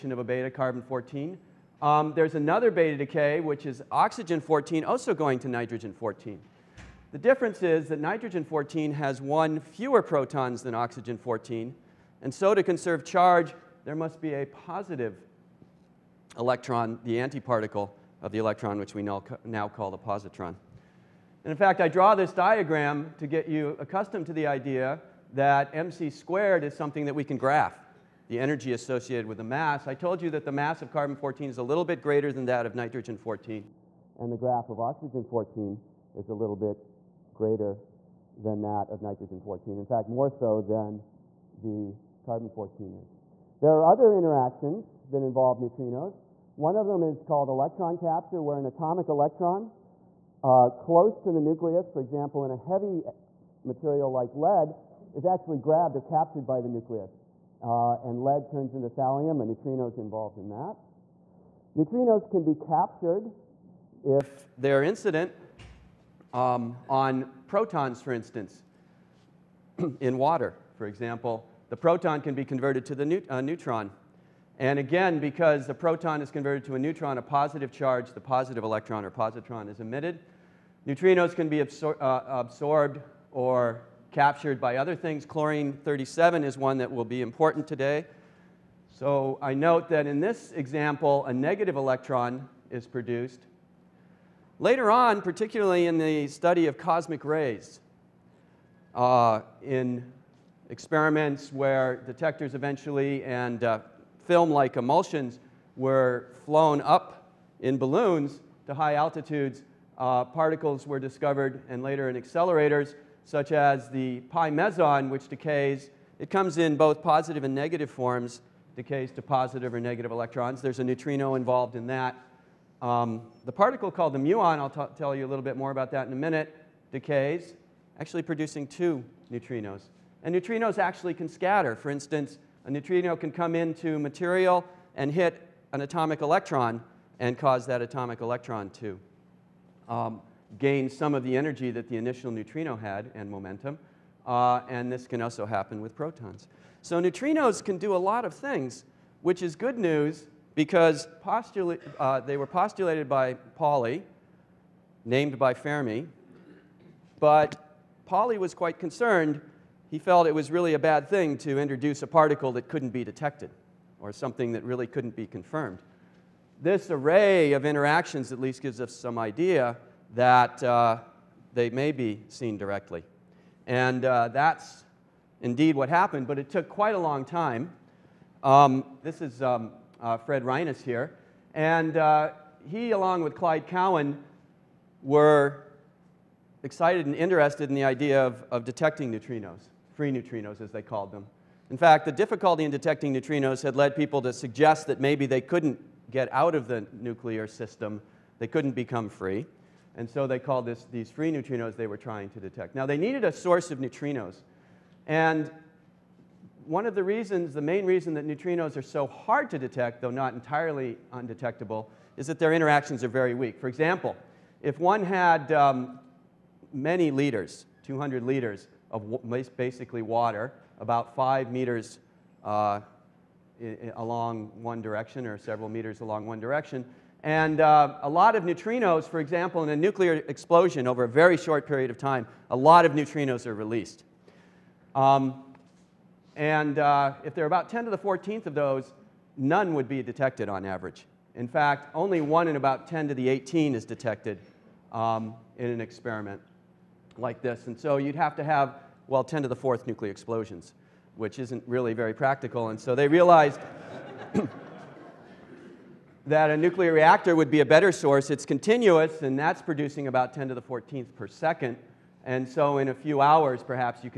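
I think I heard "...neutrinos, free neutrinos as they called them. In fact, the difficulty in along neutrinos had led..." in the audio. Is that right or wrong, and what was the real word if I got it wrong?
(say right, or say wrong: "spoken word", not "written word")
wrong: "detecting", not "along".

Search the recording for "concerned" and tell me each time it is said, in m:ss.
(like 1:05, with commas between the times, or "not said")
2:38.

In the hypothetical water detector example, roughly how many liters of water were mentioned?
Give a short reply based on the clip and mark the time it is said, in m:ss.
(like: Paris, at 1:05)
200 liters, at 3:37.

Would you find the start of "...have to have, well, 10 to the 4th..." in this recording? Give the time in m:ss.
4:08.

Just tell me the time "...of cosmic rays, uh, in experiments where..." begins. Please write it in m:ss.
1:36.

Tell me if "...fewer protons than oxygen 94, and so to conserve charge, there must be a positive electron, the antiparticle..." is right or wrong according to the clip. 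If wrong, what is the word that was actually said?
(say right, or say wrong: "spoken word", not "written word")
wrong: "14", not "94".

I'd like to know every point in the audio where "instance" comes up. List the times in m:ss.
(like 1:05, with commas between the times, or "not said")
1:08, 2:11.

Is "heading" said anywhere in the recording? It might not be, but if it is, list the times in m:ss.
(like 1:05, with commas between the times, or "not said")
not said.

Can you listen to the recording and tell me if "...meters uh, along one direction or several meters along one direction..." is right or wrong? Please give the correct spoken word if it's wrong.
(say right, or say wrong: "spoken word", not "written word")
right.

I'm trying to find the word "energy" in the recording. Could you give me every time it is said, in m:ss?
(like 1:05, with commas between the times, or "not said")
0:28, 2:21.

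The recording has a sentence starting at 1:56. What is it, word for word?
It comes in both positive and negative forms, decays to positive or negative electrons.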